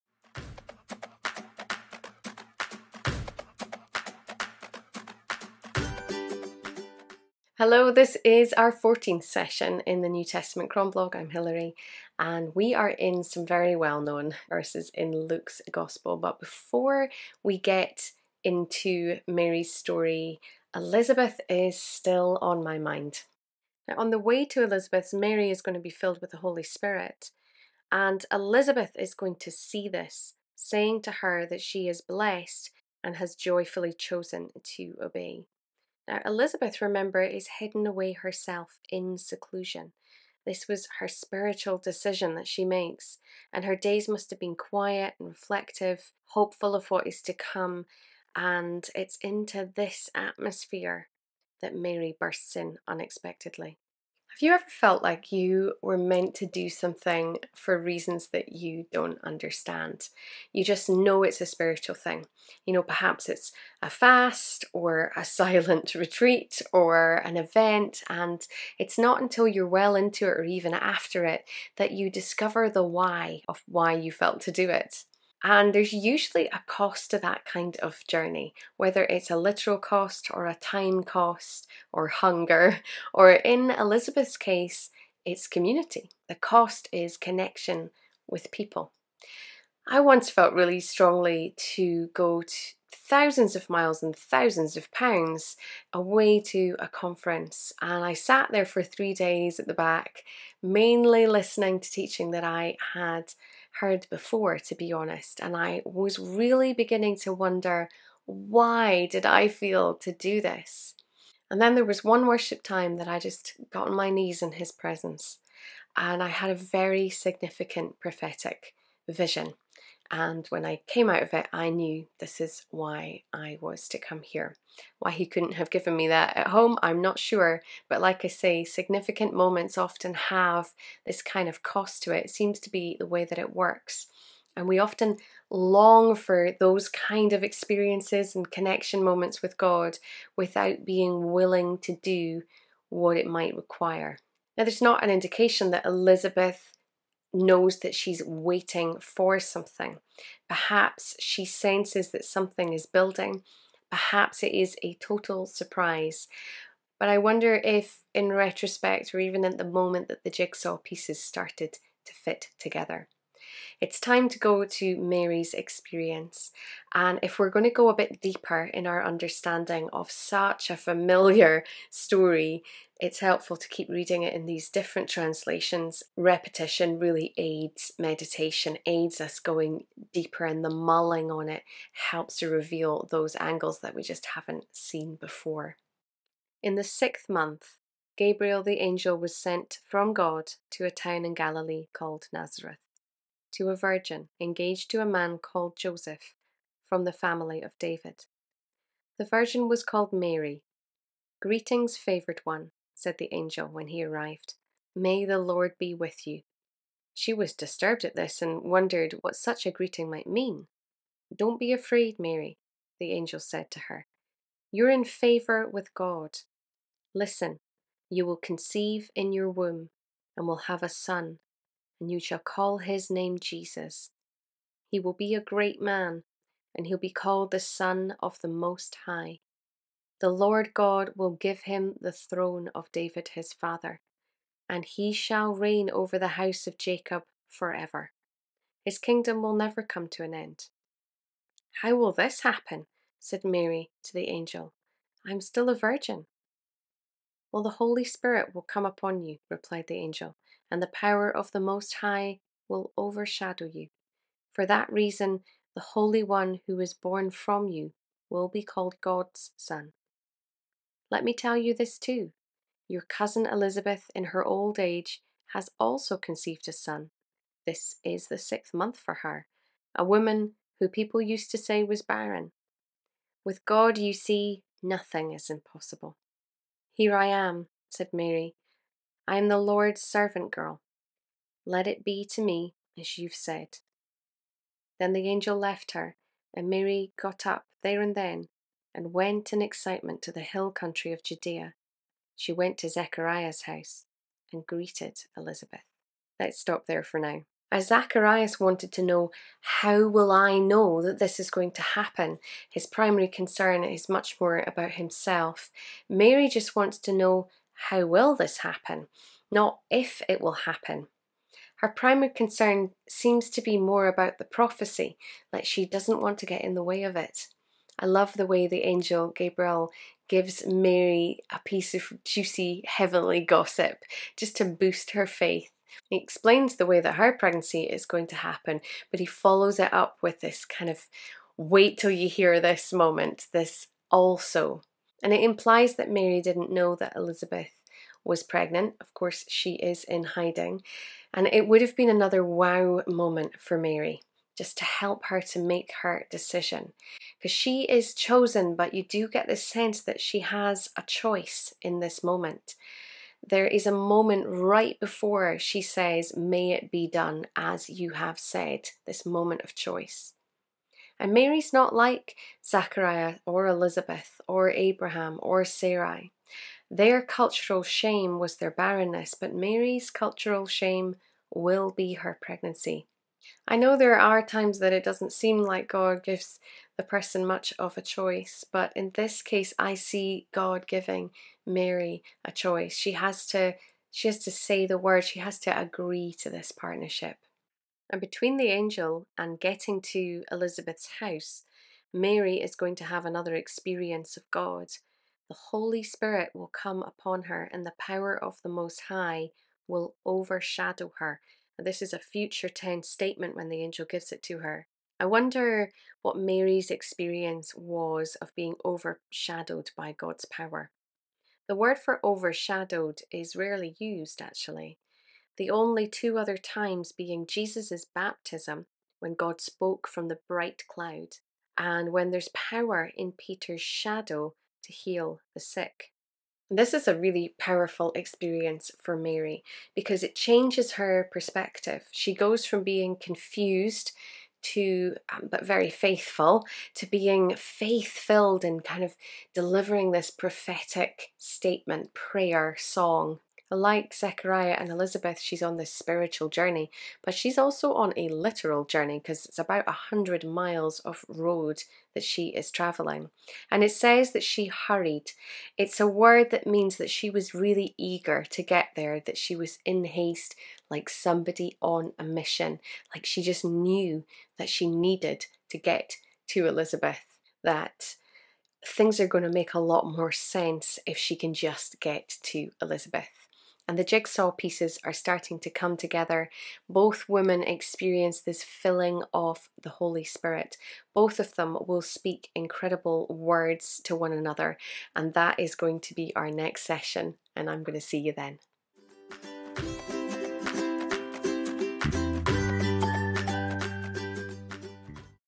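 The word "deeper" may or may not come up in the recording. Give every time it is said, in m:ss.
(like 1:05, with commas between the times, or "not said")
2:48, 3:00.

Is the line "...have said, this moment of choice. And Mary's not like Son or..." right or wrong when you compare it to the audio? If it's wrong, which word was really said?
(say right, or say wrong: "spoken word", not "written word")
wrong: "Zachariah", not "Son".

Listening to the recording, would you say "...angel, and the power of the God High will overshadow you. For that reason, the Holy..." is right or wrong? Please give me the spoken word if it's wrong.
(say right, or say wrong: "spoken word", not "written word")
wrong: "Most", not "God".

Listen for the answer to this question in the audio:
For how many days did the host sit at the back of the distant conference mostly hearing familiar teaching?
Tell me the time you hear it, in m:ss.
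1:38.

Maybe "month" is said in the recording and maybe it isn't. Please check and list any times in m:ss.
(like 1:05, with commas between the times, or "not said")
3:07, 4:28.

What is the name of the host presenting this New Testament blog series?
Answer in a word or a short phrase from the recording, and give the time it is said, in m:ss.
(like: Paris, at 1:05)
Hilary, at 0:11.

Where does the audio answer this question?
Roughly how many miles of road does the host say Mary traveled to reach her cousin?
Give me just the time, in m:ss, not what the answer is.
7:29.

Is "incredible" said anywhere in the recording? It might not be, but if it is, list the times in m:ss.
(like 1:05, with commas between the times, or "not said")
8:02.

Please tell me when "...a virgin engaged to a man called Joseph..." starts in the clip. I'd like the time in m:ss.
3:13.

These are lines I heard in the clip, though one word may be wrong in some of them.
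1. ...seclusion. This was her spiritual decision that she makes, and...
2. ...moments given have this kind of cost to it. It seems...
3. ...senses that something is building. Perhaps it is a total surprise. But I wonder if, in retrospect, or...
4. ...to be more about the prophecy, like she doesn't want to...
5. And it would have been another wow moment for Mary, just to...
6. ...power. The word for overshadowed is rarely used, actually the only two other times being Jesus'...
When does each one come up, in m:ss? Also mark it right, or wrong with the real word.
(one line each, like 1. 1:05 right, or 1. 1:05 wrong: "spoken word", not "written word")
1. 0:39 right
2. 2:09 wrong: "often", not "given"
3. 2:31 right
4. 5:13 right
5. 5:41 right
6. 6:50 right.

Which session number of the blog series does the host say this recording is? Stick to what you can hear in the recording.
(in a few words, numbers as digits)
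14th.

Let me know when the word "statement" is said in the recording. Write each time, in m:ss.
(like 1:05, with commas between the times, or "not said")
6:43, 7:21.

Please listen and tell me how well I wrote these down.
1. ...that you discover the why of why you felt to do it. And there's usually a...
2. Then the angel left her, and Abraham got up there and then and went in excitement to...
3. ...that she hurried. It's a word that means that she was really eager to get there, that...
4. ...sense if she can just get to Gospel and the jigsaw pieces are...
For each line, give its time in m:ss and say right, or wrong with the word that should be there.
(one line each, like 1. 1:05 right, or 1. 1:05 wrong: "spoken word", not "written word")
1. 1:11 right
2. 4:44 wrong: "Mary", not "Abraham"
3. 7:34 right
4. 7:50 wrong: "Elizabeth", not "Gospel".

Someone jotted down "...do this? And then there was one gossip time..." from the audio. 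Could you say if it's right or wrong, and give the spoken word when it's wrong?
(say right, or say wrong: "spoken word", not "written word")
wrong: "worship", not "gossip".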